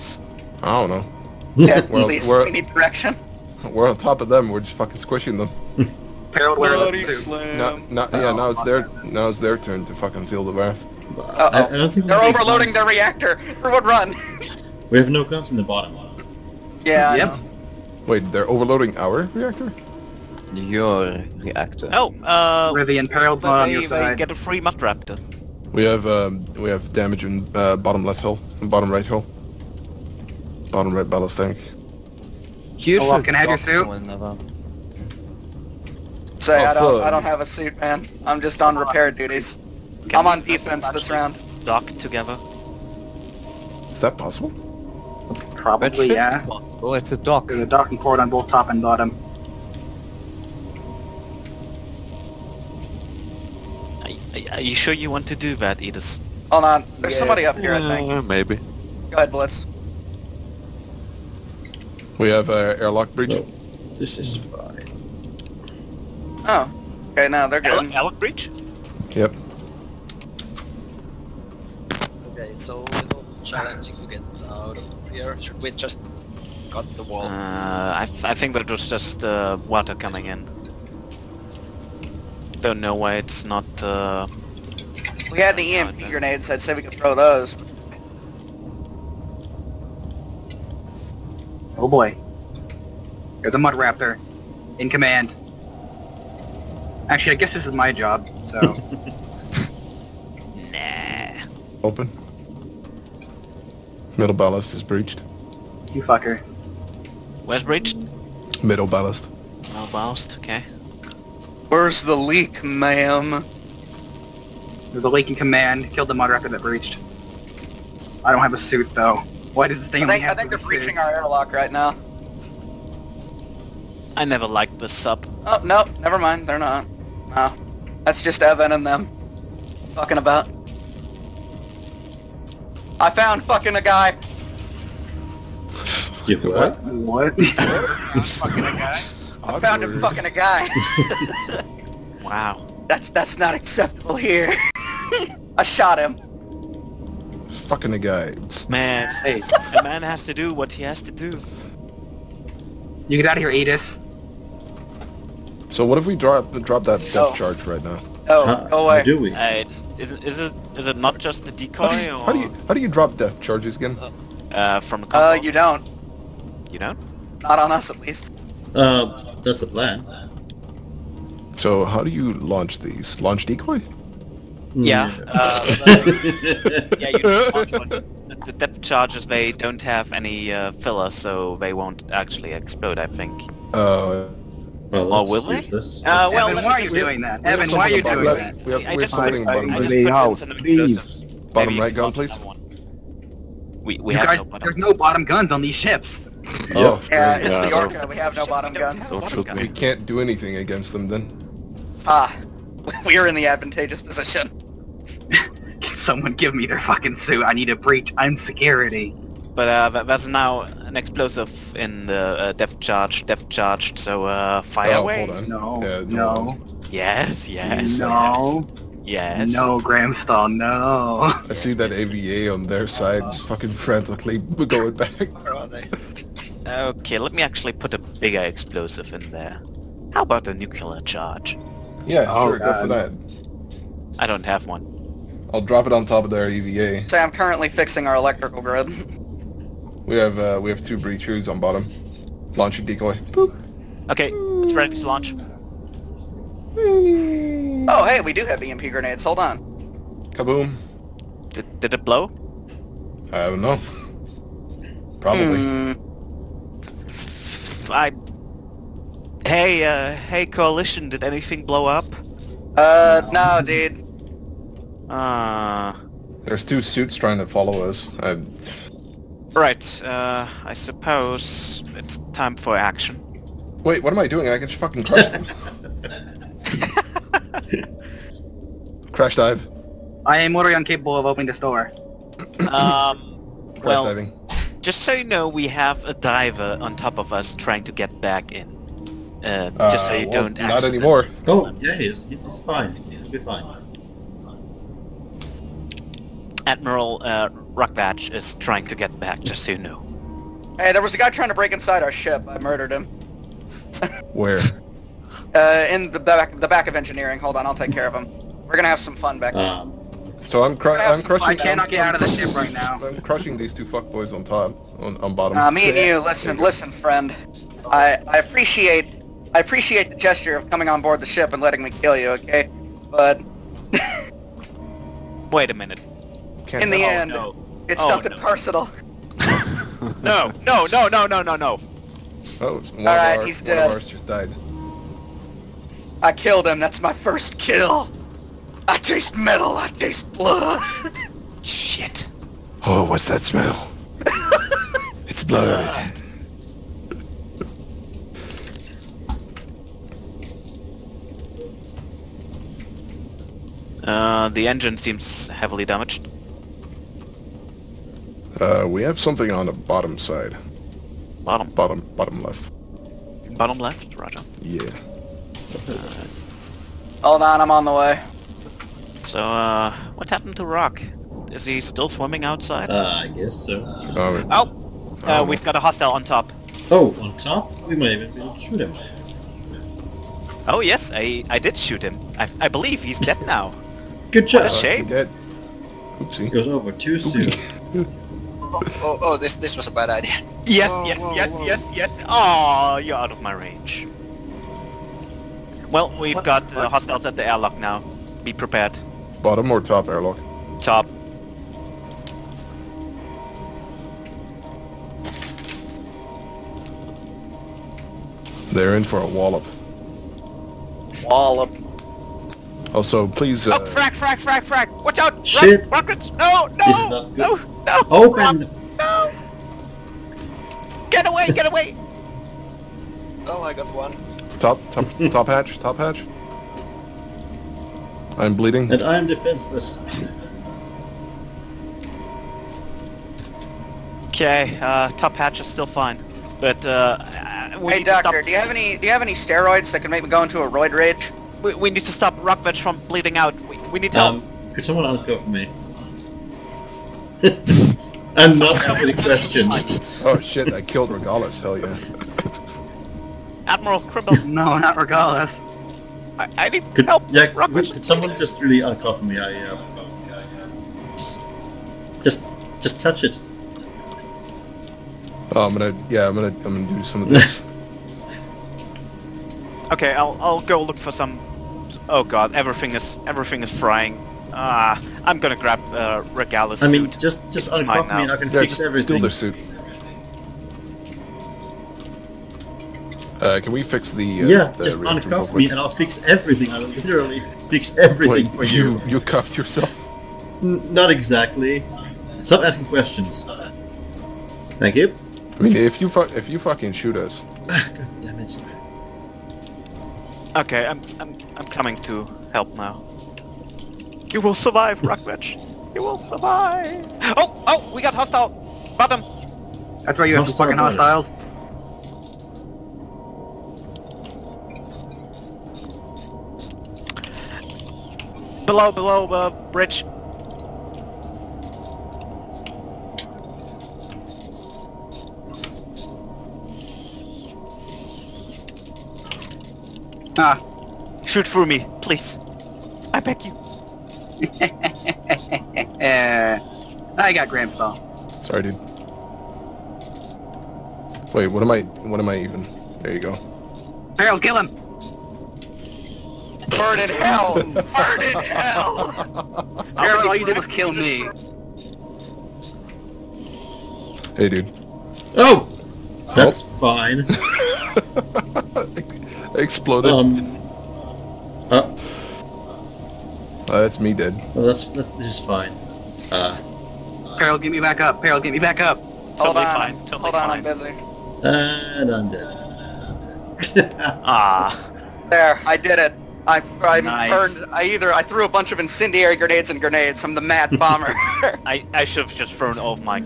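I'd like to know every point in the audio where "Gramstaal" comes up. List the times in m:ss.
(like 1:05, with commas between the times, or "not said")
3:39, 8:57.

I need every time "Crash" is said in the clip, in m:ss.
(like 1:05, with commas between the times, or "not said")
4:39, 4:43.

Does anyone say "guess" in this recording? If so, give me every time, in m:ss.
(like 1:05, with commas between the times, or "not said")
1:37, 6:13.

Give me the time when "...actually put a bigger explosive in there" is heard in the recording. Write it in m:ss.
3:47.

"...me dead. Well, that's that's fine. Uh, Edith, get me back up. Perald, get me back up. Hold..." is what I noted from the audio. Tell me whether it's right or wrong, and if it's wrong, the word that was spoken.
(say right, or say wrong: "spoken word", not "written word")
wrong: "Perald", not "Edith".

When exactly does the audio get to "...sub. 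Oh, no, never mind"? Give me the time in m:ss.
2:04.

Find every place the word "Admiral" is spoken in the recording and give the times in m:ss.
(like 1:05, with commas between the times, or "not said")
4:56, 7:33.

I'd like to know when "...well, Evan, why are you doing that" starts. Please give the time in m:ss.
3:06.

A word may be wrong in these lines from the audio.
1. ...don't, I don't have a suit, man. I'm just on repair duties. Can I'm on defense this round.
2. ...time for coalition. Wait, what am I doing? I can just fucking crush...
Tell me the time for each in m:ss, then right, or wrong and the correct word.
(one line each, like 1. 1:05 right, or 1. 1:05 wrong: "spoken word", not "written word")
1. 0:36 right
2. 4:32 wrong: "action", not "coalition".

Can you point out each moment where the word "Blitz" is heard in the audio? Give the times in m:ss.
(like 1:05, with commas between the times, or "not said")
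0:59.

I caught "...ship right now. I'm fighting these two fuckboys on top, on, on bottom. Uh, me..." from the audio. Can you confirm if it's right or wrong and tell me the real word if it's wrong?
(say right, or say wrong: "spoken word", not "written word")
wrong: "crushing", not "fighting".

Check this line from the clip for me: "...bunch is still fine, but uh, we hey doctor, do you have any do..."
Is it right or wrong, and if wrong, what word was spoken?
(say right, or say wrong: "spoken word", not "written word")
wrong: "hatch", not "bunch".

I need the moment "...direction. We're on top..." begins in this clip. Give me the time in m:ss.
0:02.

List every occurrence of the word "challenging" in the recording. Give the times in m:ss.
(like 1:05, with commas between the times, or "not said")
1:13.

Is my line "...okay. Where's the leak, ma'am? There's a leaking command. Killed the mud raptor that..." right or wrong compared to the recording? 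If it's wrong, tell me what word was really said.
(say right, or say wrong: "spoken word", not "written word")
right.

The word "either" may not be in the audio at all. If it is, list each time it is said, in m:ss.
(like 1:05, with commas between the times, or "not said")
9:37.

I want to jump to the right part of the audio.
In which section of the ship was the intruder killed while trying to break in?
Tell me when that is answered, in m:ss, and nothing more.
5:06.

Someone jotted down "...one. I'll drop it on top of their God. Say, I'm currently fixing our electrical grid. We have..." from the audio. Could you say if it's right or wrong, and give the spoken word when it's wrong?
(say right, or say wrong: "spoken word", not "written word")
wrong: "EVA", not "God".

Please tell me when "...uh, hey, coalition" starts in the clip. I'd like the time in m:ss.
4:19.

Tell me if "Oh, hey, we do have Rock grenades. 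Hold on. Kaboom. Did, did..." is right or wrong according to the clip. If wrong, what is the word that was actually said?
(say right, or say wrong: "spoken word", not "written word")
wrong: "EMP", not "Rock".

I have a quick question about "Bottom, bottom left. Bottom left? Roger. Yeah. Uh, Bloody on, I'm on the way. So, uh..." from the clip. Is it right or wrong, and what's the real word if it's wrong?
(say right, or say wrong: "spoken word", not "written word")
wrong: "Hold", not "Bloody".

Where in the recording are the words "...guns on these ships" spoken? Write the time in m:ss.
3:15.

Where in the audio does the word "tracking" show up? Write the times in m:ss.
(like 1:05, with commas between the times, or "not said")
not said.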